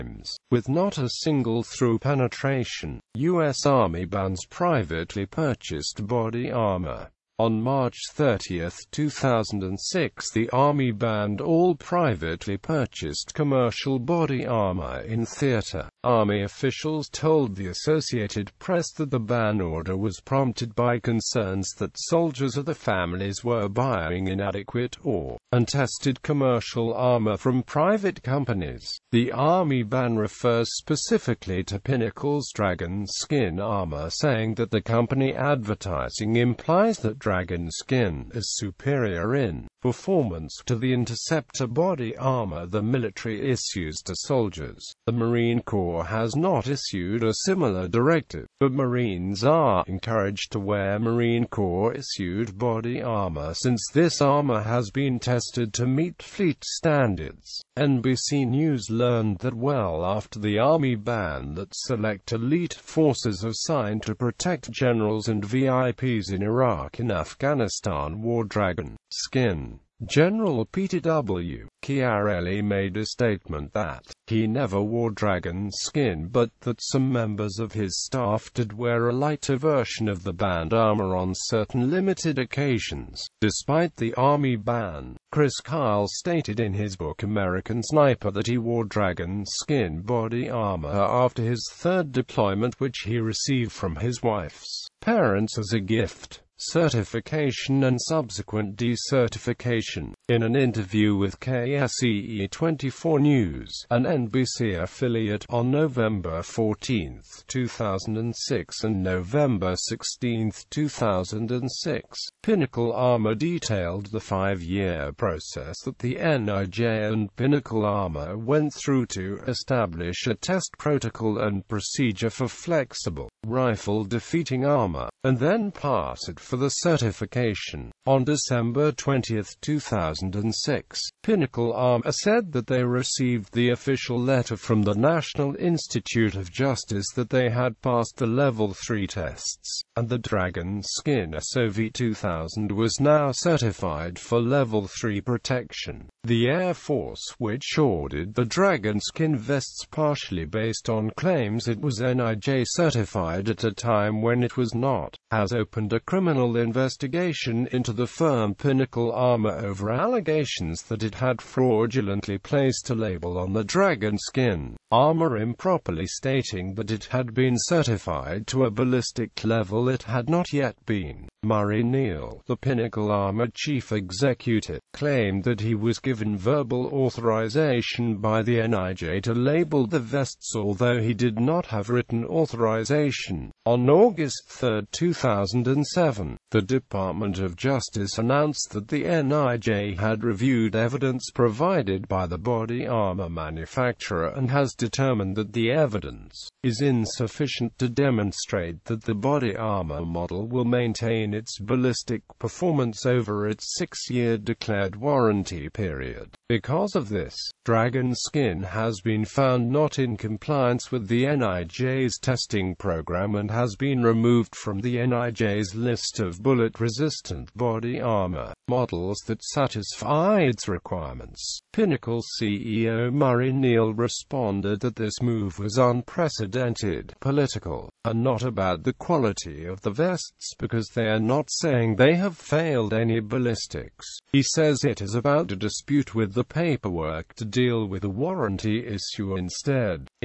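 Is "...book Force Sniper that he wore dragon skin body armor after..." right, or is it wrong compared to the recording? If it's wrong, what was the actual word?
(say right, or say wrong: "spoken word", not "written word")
wrong: "American", not "Force".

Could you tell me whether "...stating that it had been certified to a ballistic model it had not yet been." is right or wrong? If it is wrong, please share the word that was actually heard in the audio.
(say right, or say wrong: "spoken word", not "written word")
wrong: "level", not "model".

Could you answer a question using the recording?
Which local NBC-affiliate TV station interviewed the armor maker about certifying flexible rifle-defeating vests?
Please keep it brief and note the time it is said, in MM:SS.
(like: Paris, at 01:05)
KSEE24 News, at 01:41.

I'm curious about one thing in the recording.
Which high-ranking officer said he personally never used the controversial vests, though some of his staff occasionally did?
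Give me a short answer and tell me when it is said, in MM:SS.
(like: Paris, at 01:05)
Peter W. Chiarelli, at 01:10.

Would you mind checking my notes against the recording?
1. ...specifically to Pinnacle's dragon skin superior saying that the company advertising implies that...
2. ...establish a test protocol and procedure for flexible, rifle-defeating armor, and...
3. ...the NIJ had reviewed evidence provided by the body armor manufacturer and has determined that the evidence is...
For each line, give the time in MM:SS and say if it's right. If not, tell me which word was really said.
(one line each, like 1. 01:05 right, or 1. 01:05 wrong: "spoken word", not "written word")
1. 00:30 wrong: "armor", not "superior"
2. 01:59 right
3. 03:08 right.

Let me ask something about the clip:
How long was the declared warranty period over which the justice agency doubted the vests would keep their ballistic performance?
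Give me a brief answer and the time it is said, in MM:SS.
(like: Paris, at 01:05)
6 years, at 03:23.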